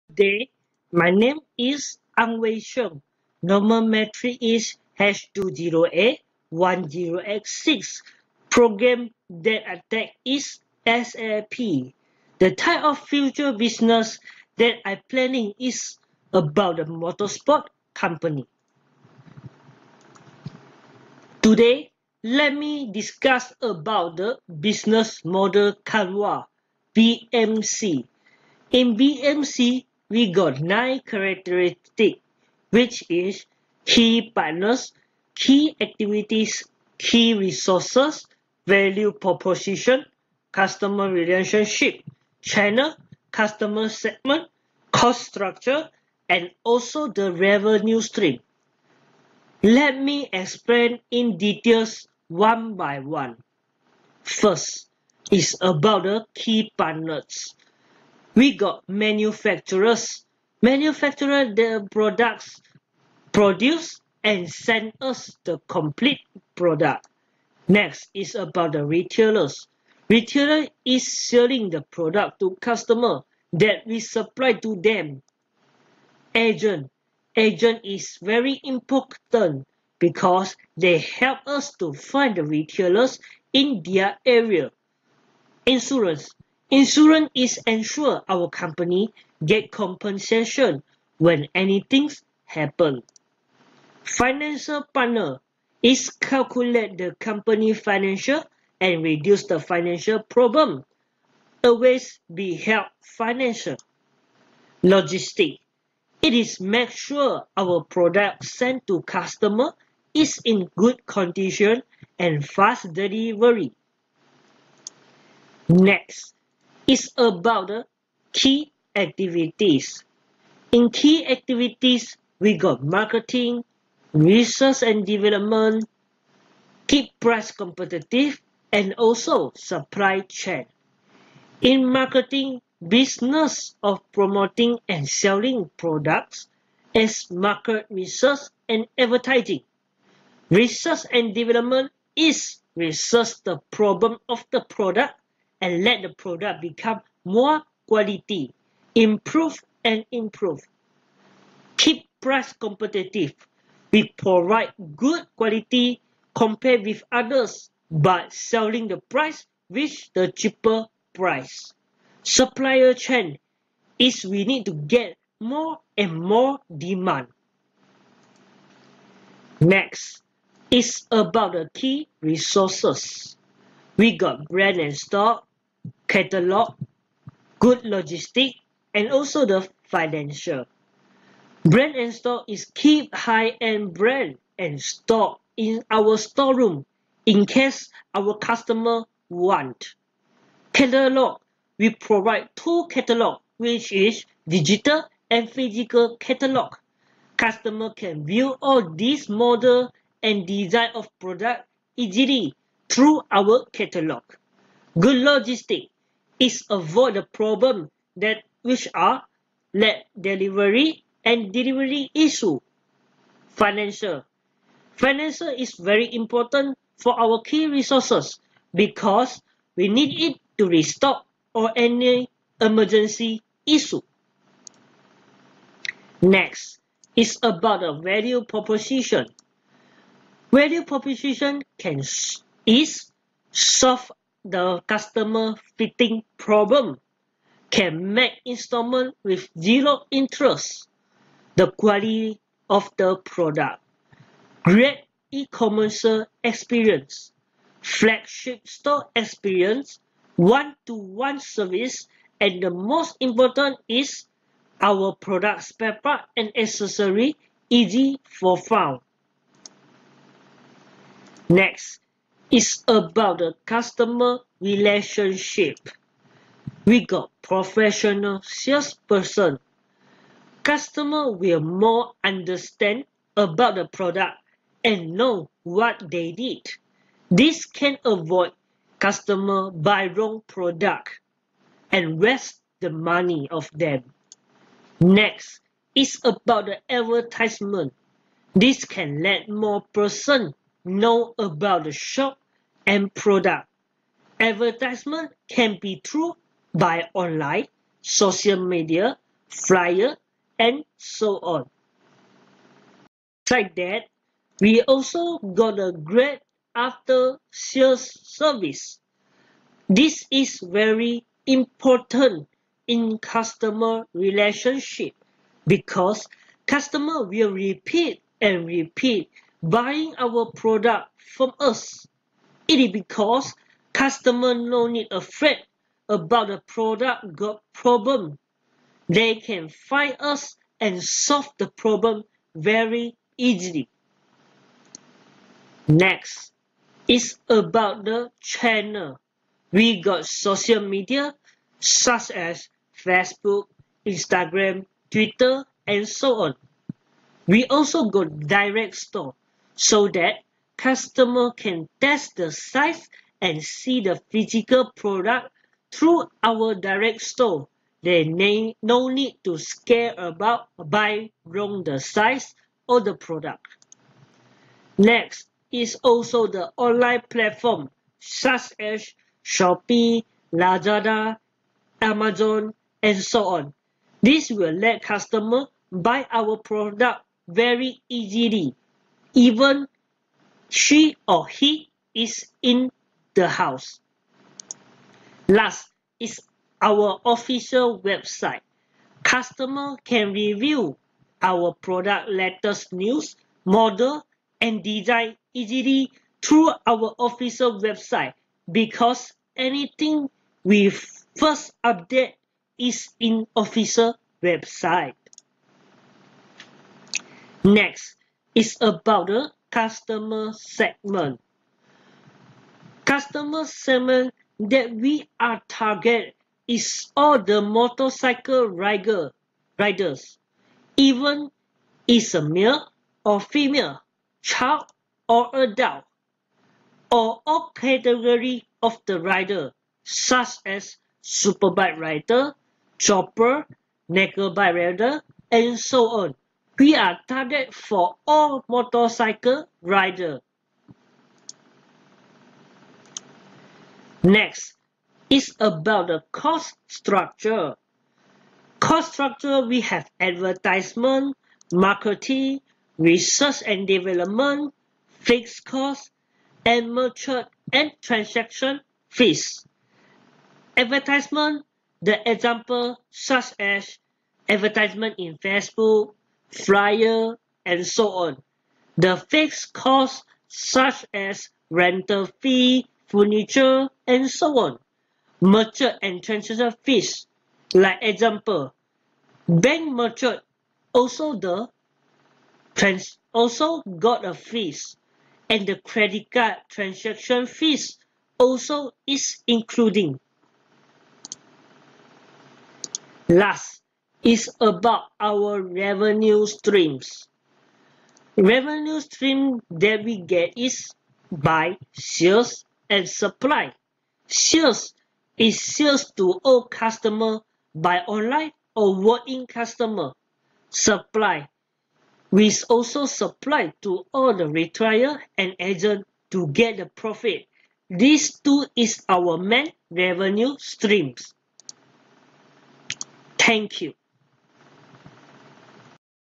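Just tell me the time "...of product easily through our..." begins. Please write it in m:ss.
3:20.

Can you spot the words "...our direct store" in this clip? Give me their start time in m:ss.
5:56.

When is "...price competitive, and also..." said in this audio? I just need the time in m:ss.
2:07.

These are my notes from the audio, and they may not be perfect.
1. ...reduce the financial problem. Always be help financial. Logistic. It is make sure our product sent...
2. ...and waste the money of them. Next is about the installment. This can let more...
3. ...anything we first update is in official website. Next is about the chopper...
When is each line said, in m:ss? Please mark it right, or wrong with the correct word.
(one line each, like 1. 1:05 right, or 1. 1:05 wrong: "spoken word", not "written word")
1. 1:39 right
2. 4:41 wrong: "advertisement", not "installment"
3. 6:39 wrong: "customer", not "chopper".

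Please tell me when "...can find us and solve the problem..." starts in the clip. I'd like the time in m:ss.
5:29.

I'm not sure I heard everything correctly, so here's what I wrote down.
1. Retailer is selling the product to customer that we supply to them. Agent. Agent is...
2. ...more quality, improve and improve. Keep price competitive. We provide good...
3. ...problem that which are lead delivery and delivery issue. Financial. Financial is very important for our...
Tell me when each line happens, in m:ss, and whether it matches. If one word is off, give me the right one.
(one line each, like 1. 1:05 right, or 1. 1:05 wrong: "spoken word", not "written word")
1. 1:10 right
2. 2:27 right
3. 3:27 right.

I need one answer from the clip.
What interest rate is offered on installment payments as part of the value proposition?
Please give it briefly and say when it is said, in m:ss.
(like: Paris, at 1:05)
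Zero interest, at 3:59.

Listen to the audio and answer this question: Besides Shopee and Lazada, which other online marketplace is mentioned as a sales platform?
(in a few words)
Amazon.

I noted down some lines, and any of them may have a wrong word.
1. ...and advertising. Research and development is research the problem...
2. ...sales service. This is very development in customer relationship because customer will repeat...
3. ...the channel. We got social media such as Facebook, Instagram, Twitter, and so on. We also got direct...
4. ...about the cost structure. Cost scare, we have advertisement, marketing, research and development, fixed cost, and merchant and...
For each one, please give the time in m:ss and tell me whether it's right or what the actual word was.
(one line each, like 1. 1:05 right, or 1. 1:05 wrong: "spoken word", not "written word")
1. 2:18 right
2. 5:07 wrong: "important", not "development"
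3. 5:38 right
4. 7:25 wrong: "structure", not "scare".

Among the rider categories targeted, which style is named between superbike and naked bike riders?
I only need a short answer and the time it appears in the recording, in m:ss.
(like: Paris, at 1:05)
Chopper, at 7:12.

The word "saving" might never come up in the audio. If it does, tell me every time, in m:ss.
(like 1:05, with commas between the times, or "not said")
not said.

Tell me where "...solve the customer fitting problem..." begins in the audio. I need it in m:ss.
3:53.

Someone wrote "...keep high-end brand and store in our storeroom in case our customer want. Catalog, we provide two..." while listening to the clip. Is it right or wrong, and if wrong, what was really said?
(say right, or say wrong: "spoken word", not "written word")
right.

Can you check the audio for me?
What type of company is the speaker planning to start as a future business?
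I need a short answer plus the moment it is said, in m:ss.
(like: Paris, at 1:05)
Motorsport company, at 0:16.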